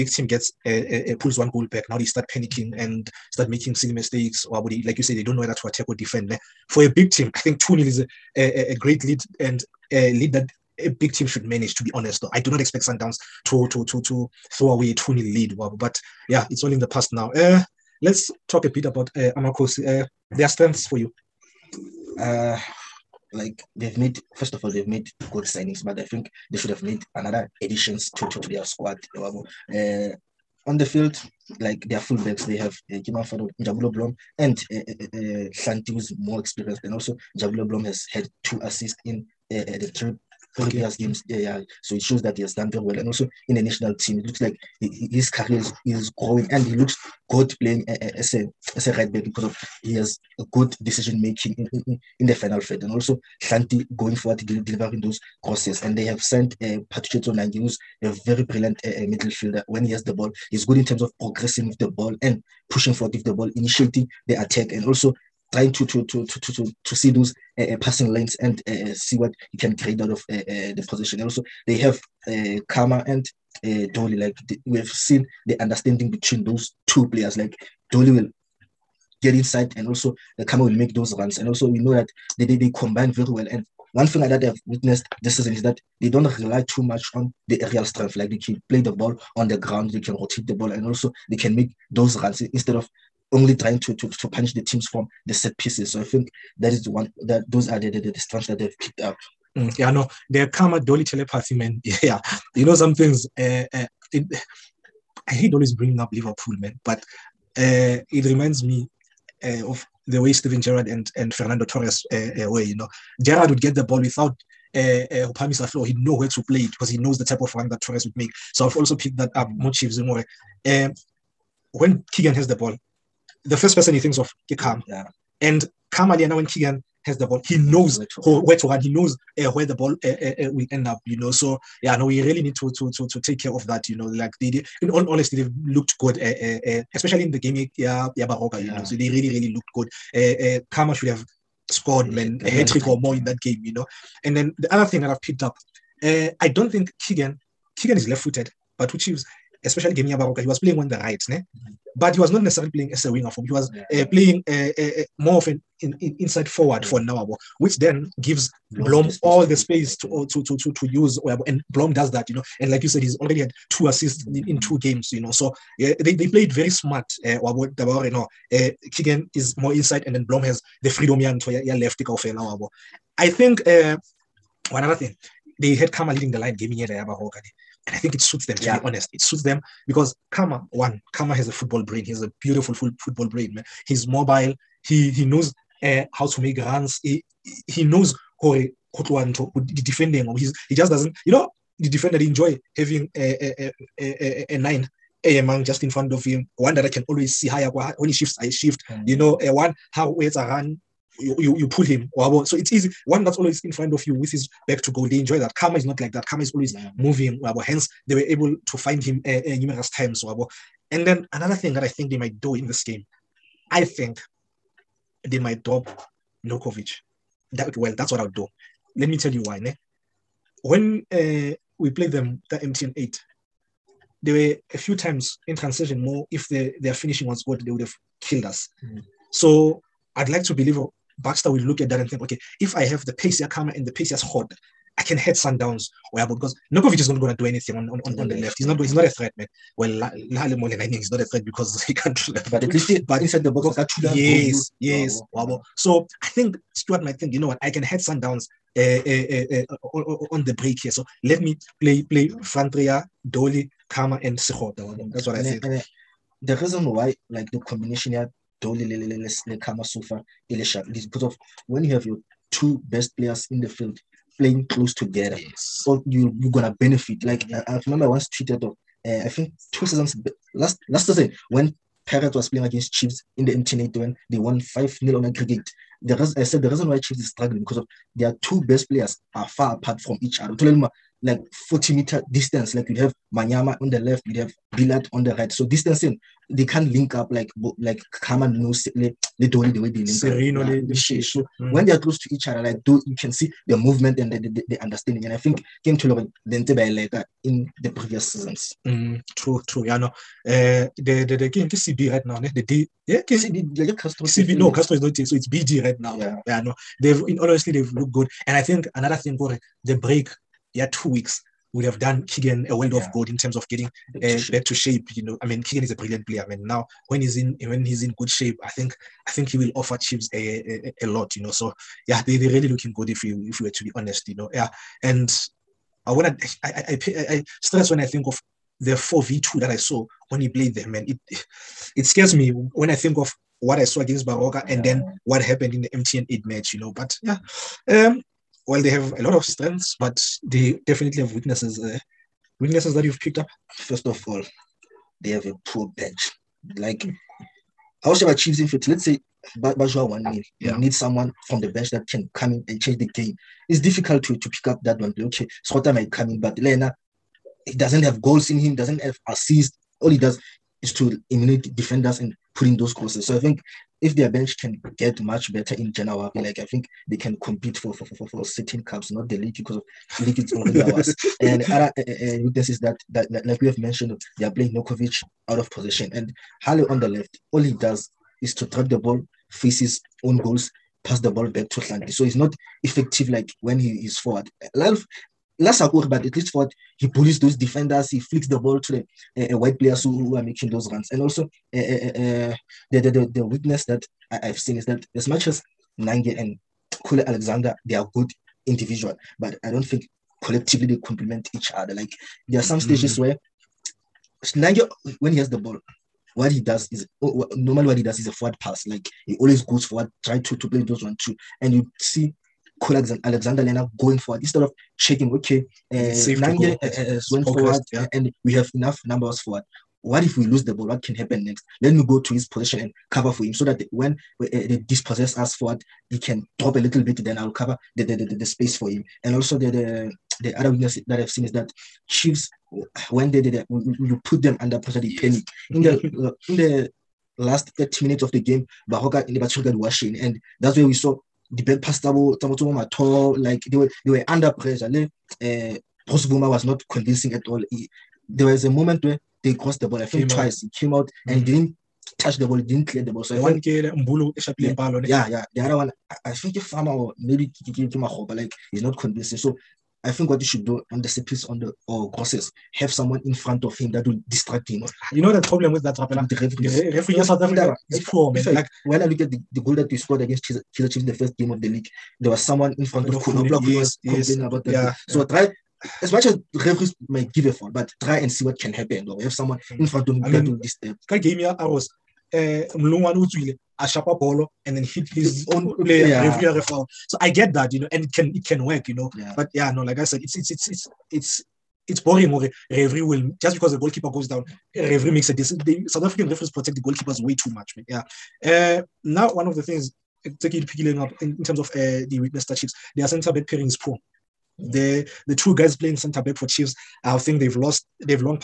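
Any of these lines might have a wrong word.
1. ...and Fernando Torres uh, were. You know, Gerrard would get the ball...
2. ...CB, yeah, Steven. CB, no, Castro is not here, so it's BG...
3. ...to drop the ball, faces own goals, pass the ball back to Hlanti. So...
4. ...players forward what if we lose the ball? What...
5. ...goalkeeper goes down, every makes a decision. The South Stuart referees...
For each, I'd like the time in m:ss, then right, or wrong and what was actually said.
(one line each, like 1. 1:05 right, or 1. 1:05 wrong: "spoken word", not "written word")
1. 1:51 right
2. 5:03 wrong: "Castro", not "Steven"
3. 6:18 right
4. 6:59 wrong: "numbers", not "players"
5. 8:13 wrong: "African", not "Stuart".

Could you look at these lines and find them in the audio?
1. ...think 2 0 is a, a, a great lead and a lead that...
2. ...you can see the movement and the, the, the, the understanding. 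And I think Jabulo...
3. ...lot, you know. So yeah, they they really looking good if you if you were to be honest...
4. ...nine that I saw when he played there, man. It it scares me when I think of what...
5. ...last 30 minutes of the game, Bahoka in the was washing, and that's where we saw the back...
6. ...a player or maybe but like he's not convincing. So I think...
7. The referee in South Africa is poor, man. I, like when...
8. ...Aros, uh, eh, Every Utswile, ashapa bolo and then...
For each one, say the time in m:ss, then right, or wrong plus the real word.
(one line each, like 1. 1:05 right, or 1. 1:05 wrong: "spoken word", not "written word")
1. 0:07 right
2. 4:53 wrong: "Kim", not "Jabulo"
3. 5:21 right
4. 5:29 wrong: "two", not "nine"
5. 7:17 right
6. 7:36 wrong: "farmer", not "player"
7. 7:46 right
8. 8:01 wrong: "Mlungwan", not "Every".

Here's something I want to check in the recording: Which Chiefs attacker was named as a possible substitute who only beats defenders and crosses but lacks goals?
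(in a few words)
Sota.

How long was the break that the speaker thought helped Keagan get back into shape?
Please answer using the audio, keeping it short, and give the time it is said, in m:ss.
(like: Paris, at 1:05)
2 weeks, at 5:10.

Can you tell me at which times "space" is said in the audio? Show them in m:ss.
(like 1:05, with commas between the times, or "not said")
2:39, 7:08.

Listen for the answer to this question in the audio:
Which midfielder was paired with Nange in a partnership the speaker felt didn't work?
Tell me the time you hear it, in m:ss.
6:37.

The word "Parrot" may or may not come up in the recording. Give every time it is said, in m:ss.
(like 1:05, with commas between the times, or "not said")
4:32.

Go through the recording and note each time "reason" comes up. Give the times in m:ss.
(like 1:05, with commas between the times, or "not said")
4:16, 4:36.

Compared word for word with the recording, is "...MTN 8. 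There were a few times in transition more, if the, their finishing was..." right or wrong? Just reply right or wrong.
right.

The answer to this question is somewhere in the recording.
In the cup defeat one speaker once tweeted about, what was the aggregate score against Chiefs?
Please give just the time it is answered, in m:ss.
4:34.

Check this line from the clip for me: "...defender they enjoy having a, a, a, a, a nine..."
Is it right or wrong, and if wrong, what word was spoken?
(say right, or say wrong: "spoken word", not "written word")
right.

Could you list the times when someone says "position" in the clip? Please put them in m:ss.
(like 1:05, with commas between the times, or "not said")
1:10, 6:15, 7:02.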